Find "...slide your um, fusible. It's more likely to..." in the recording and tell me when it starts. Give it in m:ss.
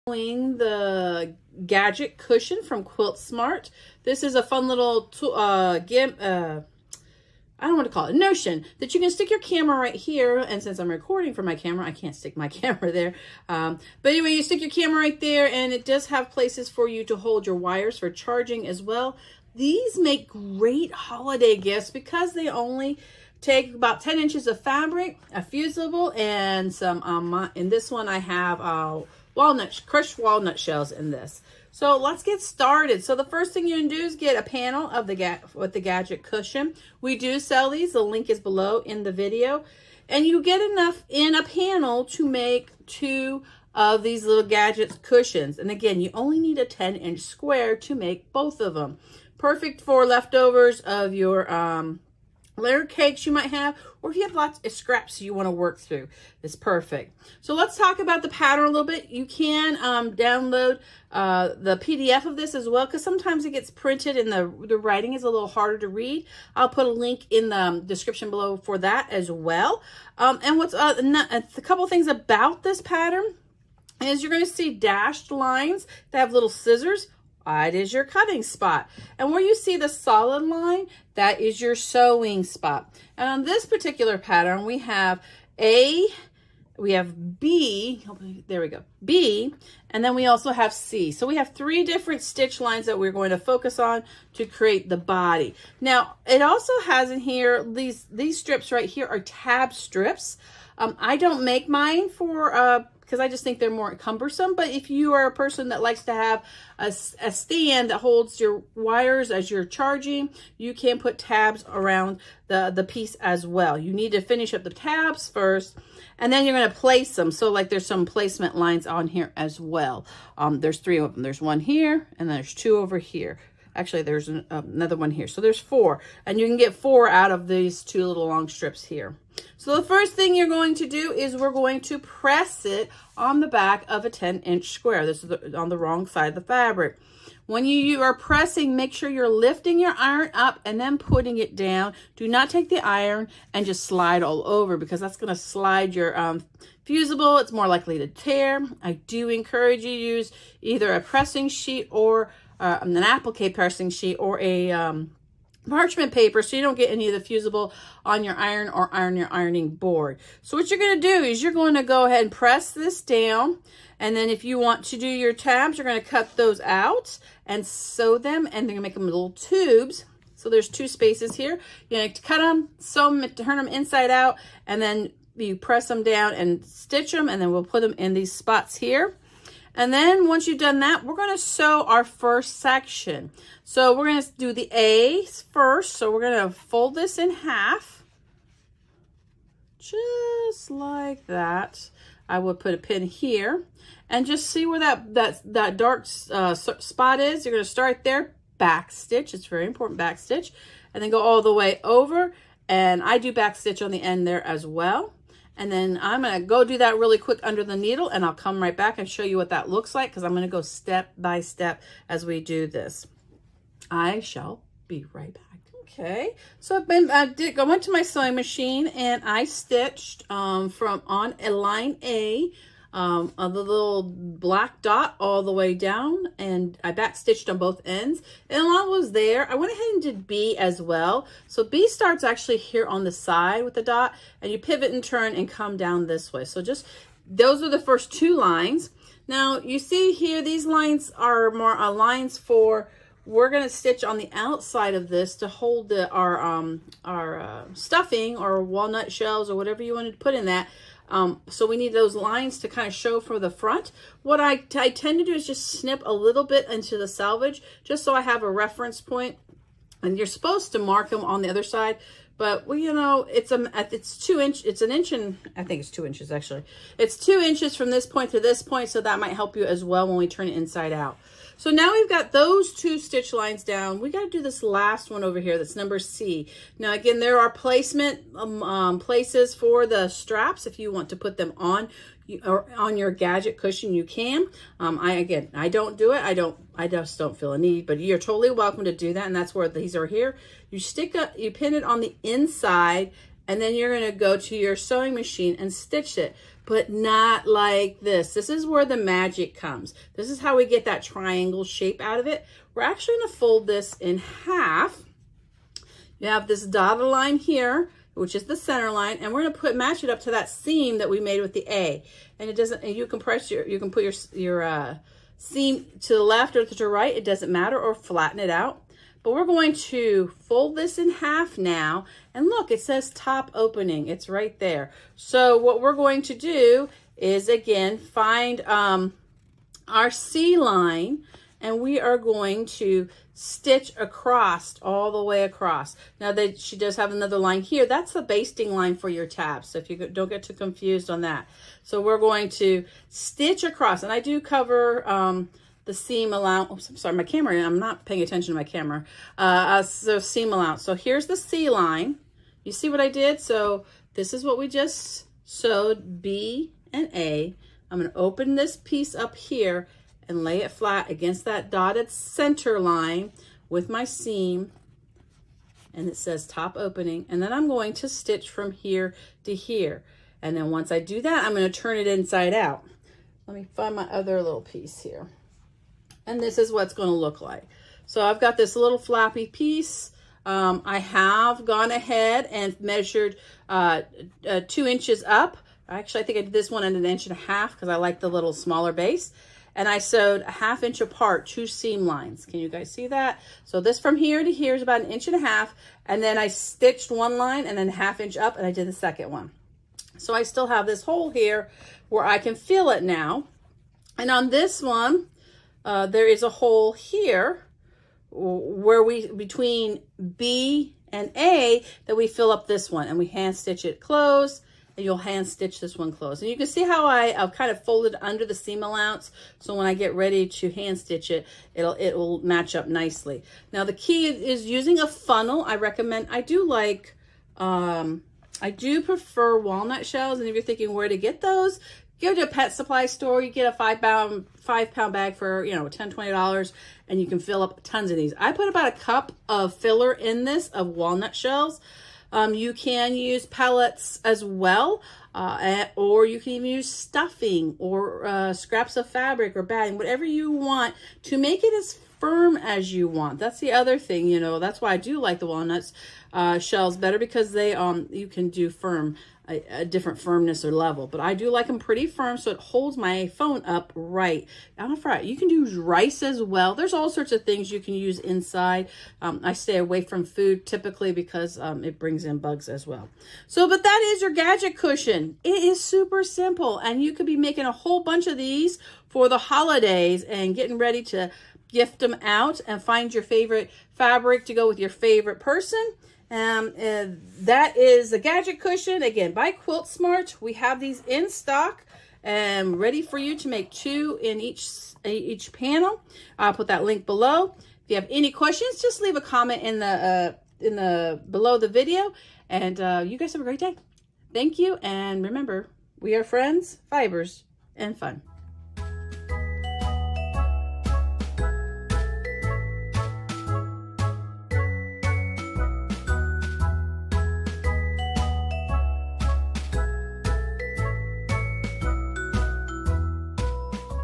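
2:25.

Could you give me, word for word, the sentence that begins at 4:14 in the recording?
What I, I tend to do is just snip a little bit into the salvage, just so I have a reference point.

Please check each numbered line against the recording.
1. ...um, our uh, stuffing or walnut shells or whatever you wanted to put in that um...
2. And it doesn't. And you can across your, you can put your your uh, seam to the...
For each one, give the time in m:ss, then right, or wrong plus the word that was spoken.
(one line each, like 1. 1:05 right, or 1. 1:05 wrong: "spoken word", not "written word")
1. 4:06 right
2. 5:12 wrong: "press", not "across".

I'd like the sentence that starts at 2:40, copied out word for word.
So what you're going to do is you're going to go ahead and press this down.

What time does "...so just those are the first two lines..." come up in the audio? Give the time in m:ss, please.
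3:56.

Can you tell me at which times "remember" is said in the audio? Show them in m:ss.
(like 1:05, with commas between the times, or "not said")
8:25.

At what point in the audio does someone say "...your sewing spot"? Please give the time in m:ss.
1:21.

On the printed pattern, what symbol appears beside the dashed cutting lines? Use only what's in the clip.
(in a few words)
Little scissors.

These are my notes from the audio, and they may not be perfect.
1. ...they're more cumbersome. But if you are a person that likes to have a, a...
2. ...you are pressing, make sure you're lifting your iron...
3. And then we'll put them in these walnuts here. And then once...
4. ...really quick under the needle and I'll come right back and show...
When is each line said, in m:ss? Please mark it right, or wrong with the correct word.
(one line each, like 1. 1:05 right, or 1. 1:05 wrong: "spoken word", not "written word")
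1. 1:43 right
2. 2:17 right
3. 2:57 wrong: "spots", not "walnuts"
4. 3:26 right.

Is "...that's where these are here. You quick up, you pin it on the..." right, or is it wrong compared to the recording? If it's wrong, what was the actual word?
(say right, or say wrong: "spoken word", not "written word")
wrong: "stick", not "quick".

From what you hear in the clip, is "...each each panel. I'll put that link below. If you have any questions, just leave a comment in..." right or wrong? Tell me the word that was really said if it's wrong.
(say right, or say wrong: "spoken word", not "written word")
right.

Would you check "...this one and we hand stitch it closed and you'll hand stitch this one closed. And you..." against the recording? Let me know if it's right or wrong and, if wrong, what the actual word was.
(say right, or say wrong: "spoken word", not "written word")
right.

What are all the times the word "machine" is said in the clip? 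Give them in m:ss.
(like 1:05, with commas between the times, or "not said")
3:38, 4:55.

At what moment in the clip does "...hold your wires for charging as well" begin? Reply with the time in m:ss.
0:17.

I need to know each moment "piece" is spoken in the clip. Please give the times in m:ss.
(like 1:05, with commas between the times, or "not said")
1:52, 5:58, 6:14, 6:19.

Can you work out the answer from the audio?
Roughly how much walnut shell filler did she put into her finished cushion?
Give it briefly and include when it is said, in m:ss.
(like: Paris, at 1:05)
About a cup, at 7:18.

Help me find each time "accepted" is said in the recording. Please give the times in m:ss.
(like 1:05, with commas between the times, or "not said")
not said.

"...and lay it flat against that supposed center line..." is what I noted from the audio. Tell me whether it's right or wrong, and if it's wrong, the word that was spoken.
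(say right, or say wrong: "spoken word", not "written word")
wrong: "dotted", not "supposed".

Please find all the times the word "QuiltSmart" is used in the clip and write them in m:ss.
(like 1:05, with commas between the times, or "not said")
0:02, 8:09.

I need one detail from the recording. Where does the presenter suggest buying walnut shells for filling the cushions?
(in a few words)
Pet supply store.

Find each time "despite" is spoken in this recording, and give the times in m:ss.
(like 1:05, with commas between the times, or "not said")
not said.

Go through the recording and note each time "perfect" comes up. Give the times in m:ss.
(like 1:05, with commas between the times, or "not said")
0:49, 0:56.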